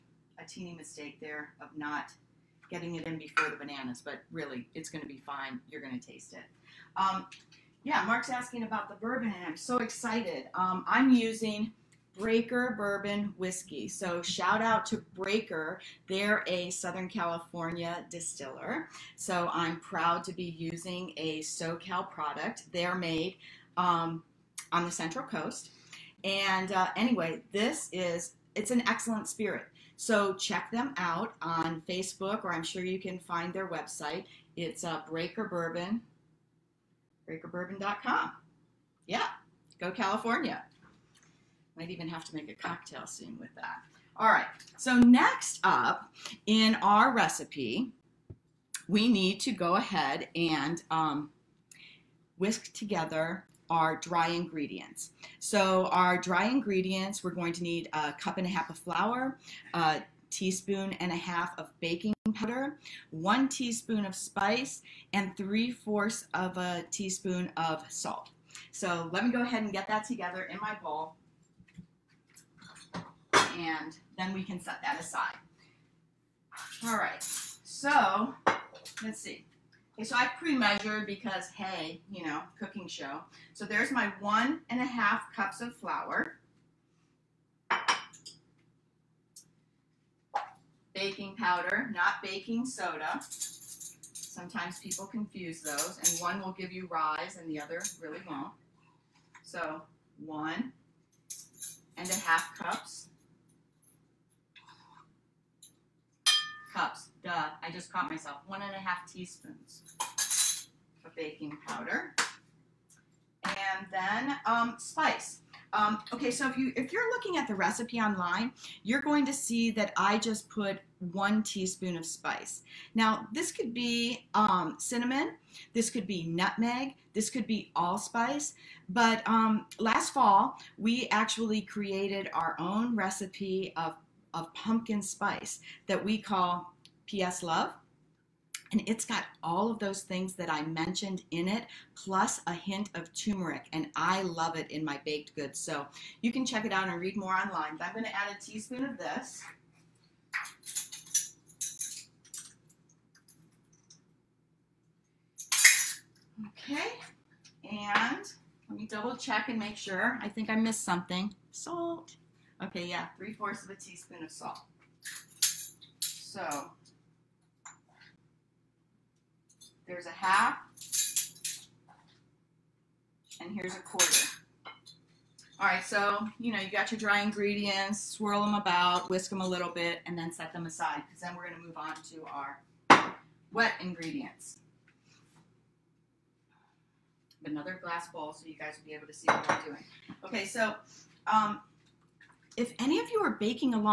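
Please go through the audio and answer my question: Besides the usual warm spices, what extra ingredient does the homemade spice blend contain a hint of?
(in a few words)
turmeric.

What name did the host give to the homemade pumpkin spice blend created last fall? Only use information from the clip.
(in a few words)
PS Love.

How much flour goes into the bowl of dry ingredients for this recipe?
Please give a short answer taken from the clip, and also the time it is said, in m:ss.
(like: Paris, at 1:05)
1 and a half cups, at 0:57.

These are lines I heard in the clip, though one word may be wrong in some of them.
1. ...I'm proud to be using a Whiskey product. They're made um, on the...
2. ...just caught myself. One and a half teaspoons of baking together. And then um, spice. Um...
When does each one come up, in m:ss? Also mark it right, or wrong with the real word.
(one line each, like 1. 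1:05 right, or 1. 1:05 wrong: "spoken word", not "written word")
1. 0:19 wrong: "SoCal", not "Whiskey"
2. 1:47 wrong: "powder", not "together".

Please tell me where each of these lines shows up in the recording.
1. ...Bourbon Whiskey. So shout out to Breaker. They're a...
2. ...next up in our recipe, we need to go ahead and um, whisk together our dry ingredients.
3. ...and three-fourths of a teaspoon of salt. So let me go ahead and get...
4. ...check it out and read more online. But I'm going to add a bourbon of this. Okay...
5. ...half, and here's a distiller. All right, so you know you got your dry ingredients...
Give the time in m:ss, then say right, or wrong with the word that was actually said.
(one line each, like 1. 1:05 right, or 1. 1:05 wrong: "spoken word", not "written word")
1. 0:12 right
2. 0:44 right
3. 1:05 right
4. 2:26 wrong: "teaspoon", not "bourbon"
5. 2:50 wrong: "quarter", not "distiller".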